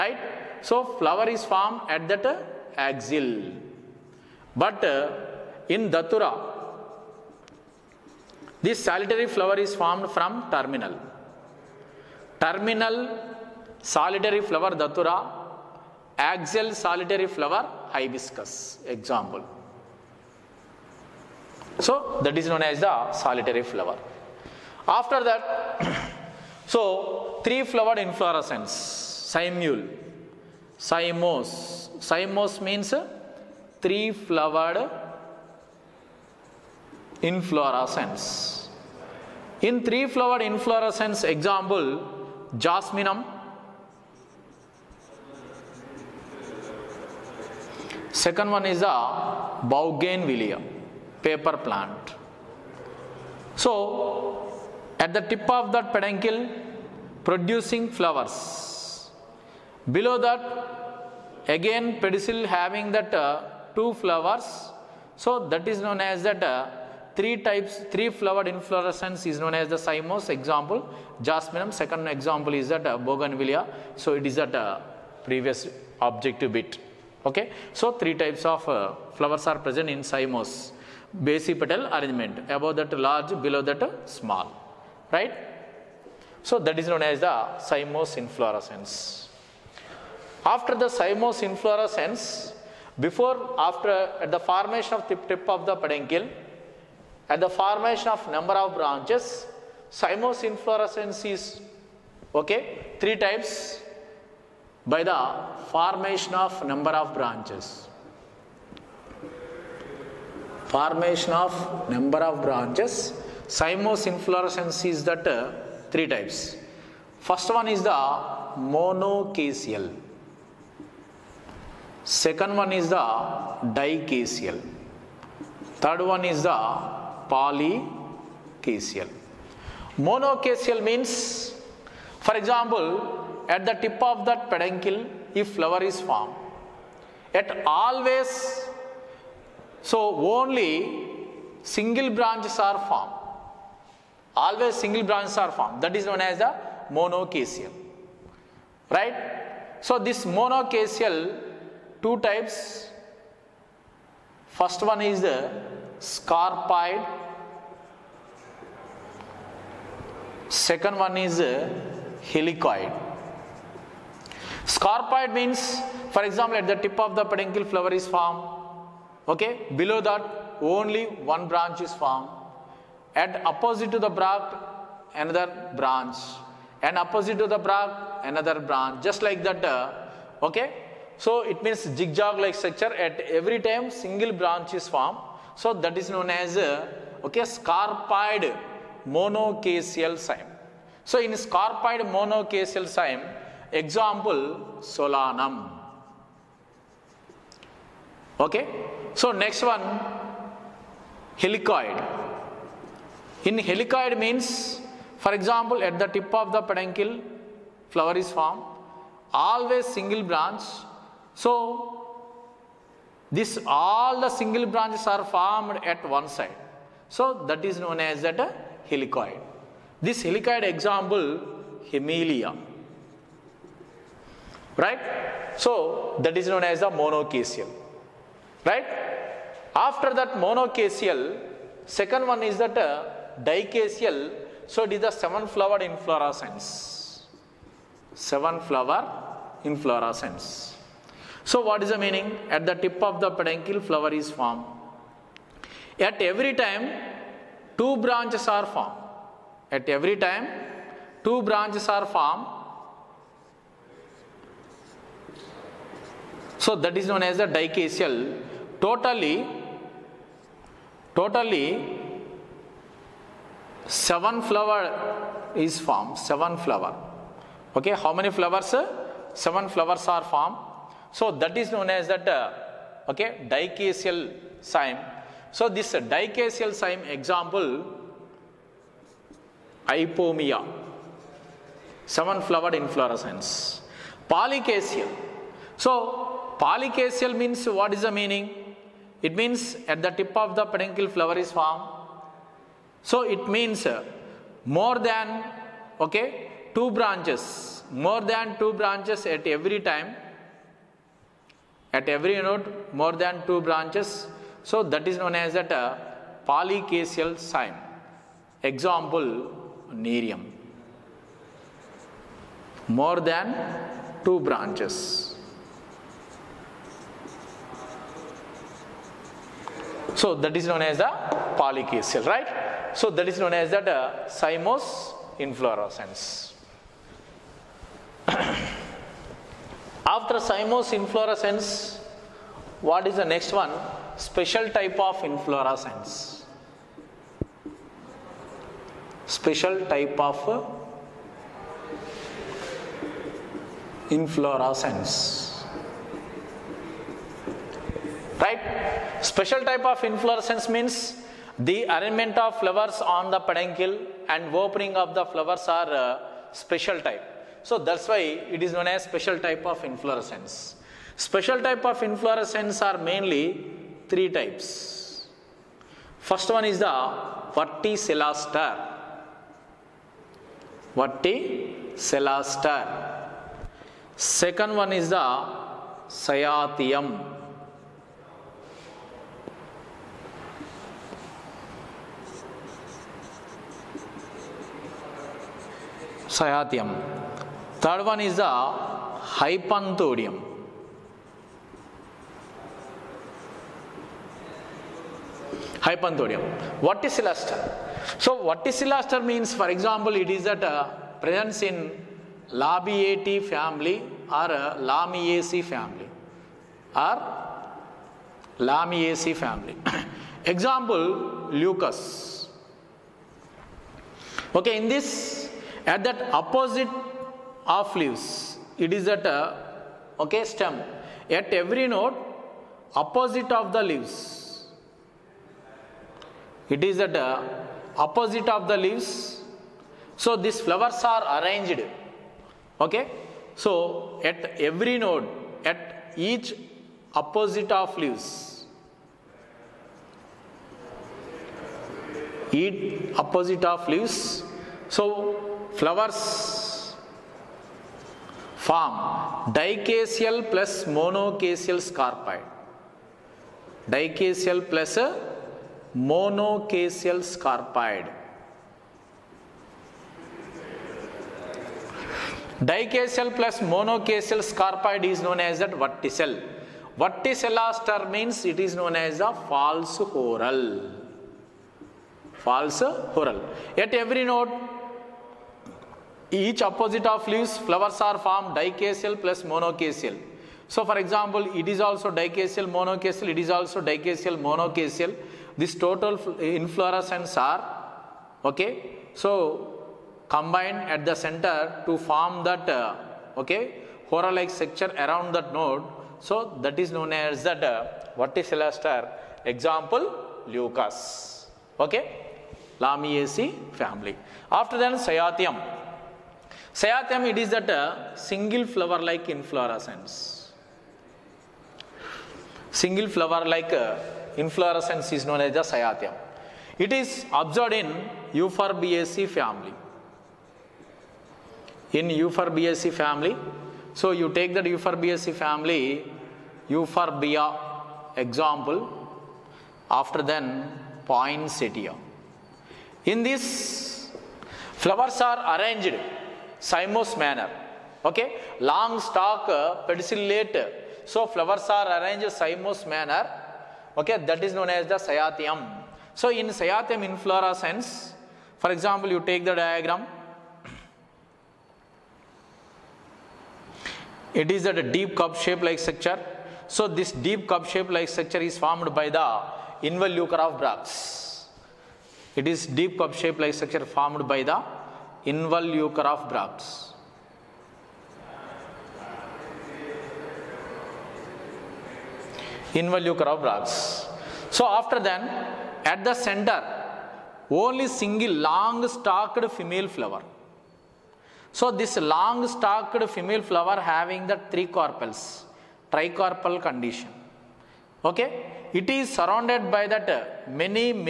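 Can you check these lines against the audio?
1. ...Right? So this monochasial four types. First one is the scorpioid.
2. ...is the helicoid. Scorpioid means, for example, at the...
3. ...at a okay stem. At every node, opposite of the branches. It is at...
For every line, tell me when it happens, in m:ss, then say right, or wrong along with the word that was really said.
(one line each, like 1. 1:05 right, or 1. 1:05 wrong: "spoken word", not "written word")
1. 2:28 wrong: "two", not "four"
2. 2:41 right
3. 6:59 wrong: "leaves", not "branches".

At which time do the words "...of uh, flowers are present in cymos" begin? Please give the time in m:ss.
1:18.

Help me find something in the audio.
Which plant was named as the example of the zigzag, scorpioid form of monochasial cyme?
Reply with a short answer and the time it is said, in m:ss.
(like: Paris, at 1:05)
Solanum, at 3:14.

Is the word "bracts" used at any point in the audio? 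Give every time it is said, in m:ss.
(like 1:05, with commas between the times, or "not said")
9:20, 9:26, 9:33.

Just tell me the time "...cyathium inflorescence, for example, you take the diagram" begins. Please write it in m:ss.
9:06.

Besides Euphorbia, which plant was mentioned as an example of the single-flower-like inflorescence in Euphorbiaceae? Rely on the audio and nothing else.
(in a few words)
Poinsettia.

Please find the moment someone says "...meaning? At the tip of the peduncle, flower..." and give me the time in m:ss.
4:01.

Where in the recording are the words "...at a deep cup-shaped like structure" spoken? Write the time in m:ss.
9:14.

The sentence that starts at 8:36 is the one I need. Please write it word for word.
It is observed in Euphorbiaceae family.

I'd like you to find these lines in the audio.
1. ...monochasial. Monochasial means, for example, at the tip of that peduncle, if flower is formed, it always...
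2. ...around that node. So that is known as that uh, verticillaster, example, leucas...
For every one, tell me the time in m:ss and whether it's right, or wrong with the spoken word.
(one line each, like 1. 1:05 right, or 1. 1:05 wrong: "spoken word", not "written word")
1. 2:07 wrong: "polychasial", not "monochasial"
2. 8:14 right.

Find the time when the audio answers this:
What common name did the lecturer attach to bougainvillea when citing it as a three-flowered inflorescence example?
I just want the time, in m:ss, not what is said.
0:51.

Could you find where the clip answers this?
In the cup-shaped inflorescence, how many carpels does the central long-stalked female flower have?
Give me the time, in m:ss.
9:44.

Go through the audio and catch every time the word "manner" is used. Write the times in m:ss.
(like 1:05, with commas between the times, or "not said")
8:57, 9:02.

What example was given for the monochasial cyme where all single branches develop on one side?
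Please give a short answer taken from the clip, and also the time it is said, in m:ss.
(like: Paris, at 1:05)
Hamelia, at 3:41.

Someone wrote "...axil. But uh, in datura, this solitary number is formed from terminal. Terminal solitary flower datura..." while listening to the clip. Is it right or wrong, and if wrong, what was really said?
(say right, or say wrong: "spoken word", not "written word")
wrong: "flower", not "number".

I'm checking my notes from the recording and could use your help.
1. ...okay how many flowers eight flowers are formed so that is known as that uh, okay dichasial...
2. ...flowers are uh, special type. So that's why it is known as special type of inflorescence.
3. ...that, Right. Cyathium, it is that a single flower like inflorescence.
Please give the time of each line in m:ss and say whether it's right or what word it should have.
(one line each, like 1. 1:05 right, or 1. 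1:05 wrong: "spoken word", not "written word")
1. 4:27 wrong: "seven", not "eight"
2. 5:55 right
3. 8:24 wrong: "Cyathium", not "Right".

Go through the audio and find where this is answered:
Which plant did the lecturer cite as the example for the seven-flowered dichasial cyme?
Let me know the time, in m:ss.
4:39.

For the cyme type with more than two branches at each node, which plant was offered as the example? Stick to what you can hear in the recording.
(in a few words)
Nerium.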